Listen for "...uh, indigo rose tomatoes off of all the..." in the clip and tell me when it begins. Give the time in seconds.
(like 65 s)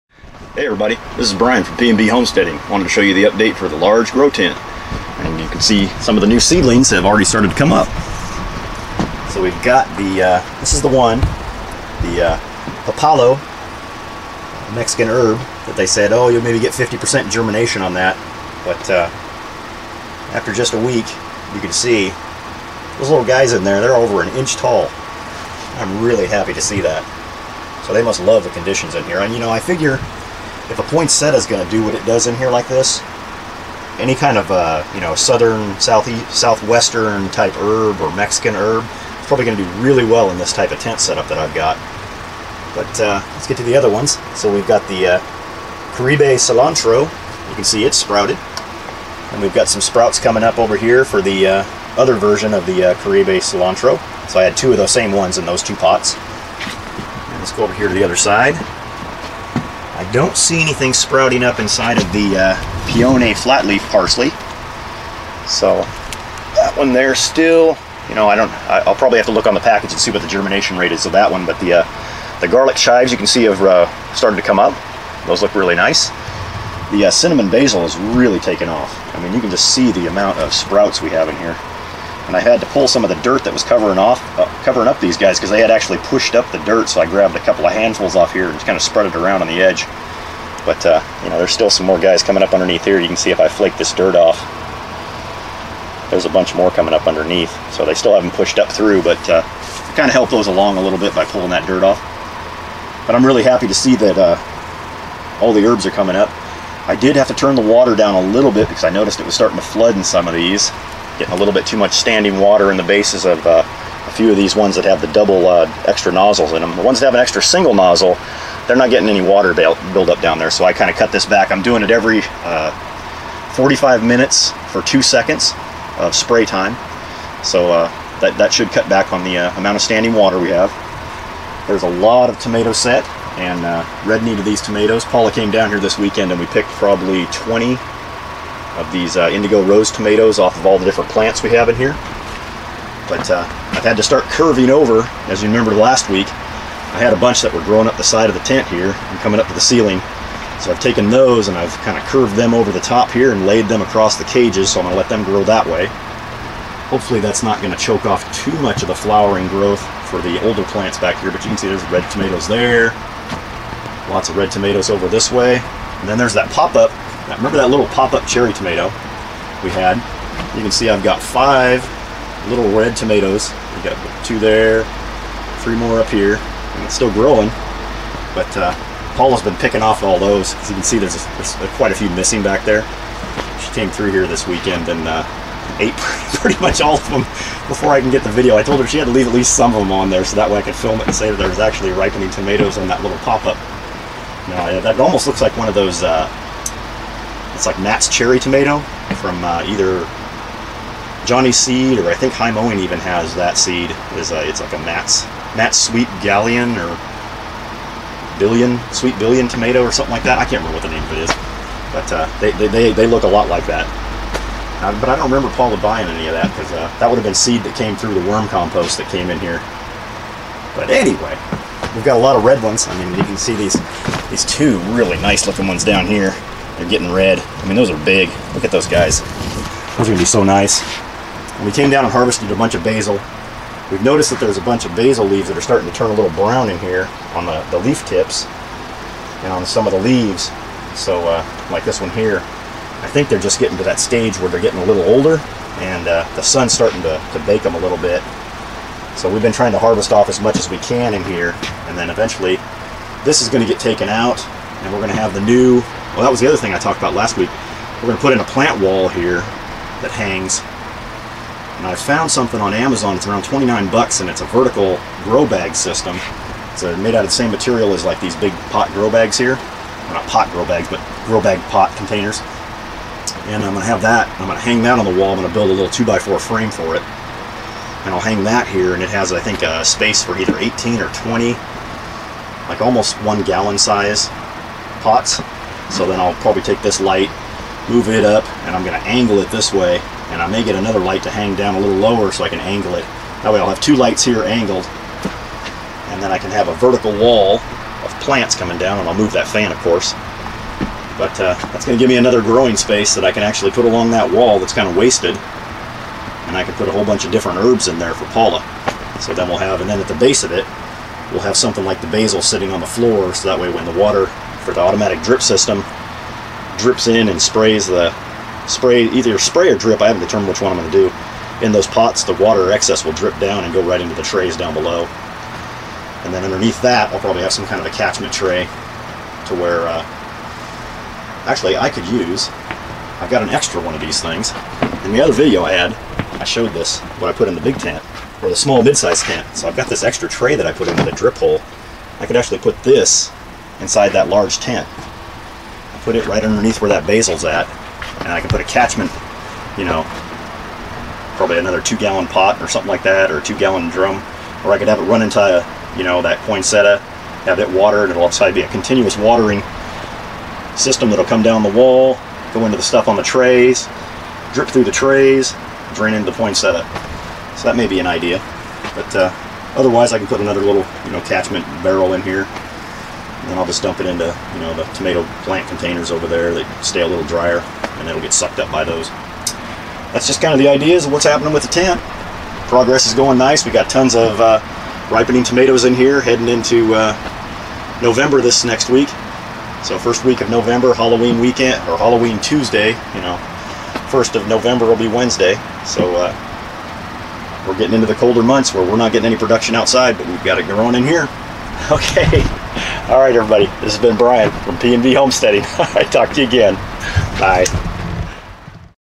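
139 s.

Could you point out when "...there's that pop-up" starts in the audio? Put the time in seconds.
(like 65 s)
166 s.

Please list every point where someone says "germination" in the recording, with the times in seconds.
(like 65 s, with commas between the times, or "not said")
17 s, 70 s.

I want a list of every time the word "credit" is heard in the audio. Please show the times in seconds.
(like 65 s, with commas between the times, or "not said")
not said.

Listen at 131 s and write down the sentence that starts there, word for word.
There's a lot of tomato set and uh, red need of these tomatoes.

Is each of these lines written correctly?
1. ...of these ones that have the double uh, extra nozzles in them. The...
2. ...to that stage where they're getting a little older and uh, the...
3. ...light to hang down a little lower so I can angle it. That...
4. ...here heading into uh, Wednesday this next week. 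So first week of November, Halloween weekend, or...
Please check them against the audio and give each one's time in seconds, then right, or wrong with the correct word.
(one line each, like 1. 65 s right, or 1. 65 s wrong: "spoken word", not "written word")
1. 114 s right
2. 243 s right
3. 290 s right
4. 385 s wrong: "November", not "Wednesday".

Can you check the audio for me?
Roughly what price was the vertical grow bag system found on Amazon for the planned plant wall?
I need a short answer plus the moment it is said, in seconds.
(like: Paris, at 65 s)
29 dollars, at 263 s.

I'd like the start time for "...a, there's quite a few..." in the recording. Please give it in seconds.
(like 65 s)
181 s.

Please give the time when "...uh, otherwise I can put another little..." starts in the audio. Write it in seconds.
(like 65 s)
369 s.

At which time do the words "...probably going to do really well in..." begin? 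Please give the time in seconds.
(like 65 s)
39 s.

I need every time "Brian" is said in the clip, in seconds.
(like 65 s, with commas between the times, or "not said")
1 s, 404 s.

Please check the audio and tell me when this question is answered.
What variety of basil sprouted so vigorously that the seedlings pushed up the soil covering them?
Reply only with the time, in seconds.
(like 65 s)
77 s.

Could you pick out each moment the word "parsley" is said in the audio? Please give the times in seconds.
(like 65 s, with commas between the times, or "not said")
63 s.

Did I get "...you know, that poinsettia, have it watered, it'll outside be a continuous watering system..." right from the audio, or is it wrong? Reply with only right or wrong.
right.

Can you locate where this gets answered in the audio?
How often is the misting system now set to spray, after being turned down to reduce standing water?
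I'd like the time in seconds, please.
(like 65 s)
121 s.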